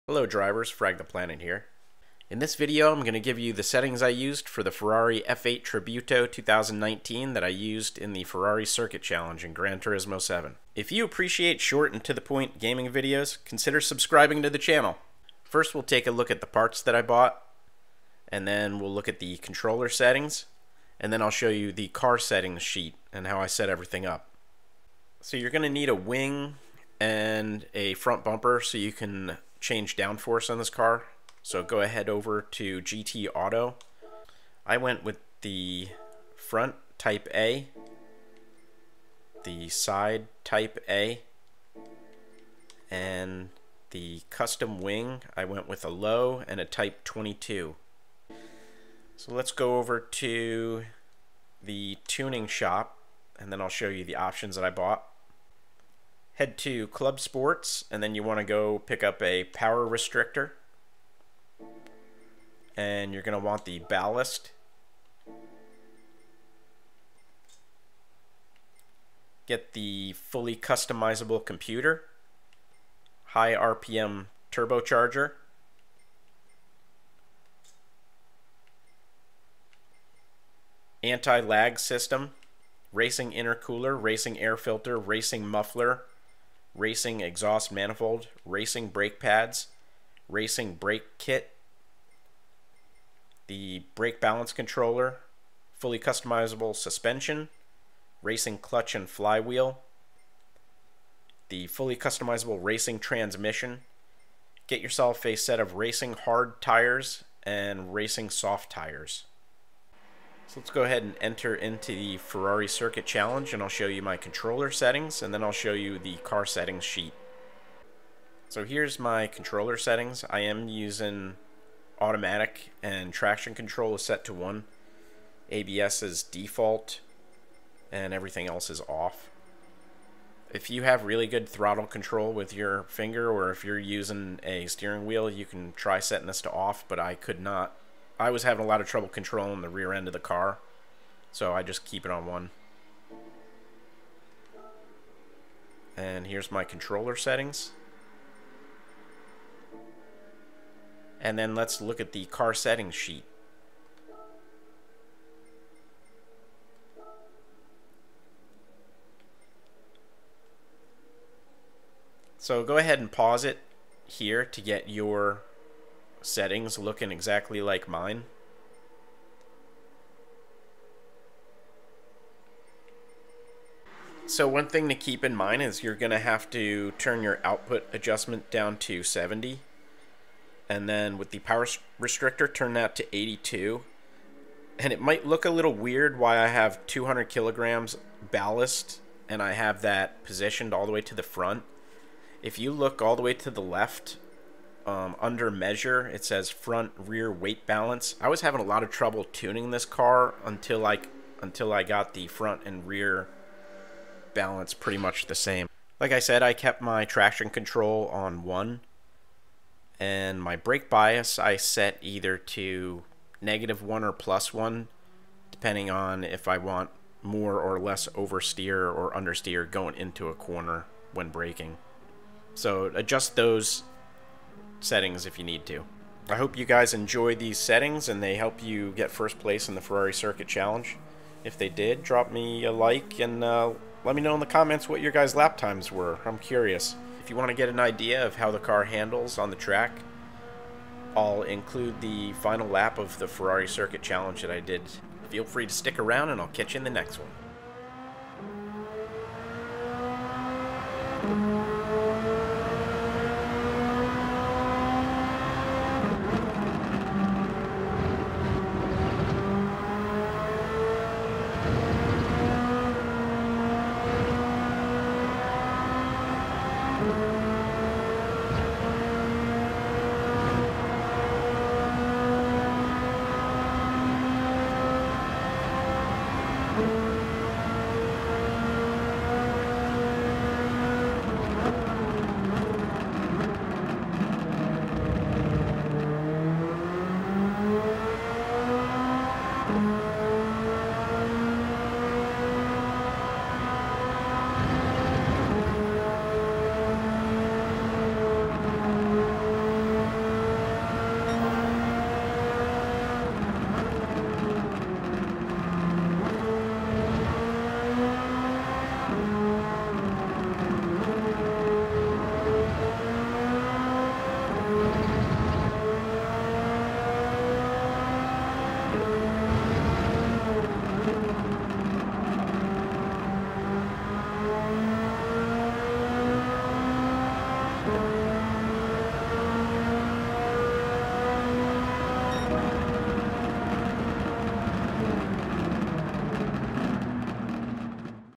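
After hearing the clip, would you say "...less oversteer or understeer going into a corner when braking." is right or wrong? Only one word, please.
right.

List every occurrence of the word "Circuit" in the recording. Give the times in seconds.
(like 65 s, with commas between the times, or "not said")
8 s, 112 s, 230 s, 243 s.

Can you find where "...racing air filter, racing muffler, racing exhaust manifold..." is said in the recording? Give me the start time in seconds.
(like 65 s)
84 s.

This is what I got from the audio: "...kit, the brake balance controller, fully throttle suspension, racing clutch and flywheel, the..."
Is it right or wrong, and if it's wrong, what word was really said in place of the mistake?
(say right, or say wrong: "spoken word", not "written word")
wrong: "customizable", not "throttle".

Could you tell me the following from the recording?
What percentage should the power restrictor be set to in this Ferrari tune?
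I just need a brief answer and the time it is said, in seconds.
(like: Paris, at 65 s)
82, at 183 s.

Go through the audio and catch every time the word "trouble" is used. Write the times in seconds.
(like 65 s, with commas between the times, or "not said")
138 s, 198 s.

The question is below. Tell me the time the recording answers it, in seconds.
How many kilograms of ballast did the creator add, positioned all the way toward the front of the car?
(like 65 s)
186 s.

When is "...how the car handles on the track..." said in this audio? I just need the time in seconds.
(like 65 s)
238 s.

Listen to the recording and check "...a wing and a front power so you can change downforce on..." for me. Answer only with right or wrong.
wrong.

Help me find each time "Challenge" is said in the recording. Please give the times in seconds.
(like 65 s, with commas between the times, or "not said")
9 s, 113 s, 230 s, 244 s.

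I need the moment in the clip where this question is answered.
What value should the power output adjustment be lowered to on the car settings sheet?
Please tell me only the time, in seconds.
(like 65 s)
179 s.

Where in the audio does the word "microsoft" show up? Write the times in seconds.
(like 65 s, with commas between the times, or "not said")
not said.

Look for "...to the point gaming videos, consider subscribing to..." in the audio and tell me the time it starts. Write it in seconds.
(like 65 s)
12 s.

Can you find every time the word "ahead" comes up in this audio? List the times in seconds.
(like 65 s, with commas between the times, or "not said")
31 s, 110 s, 162 s.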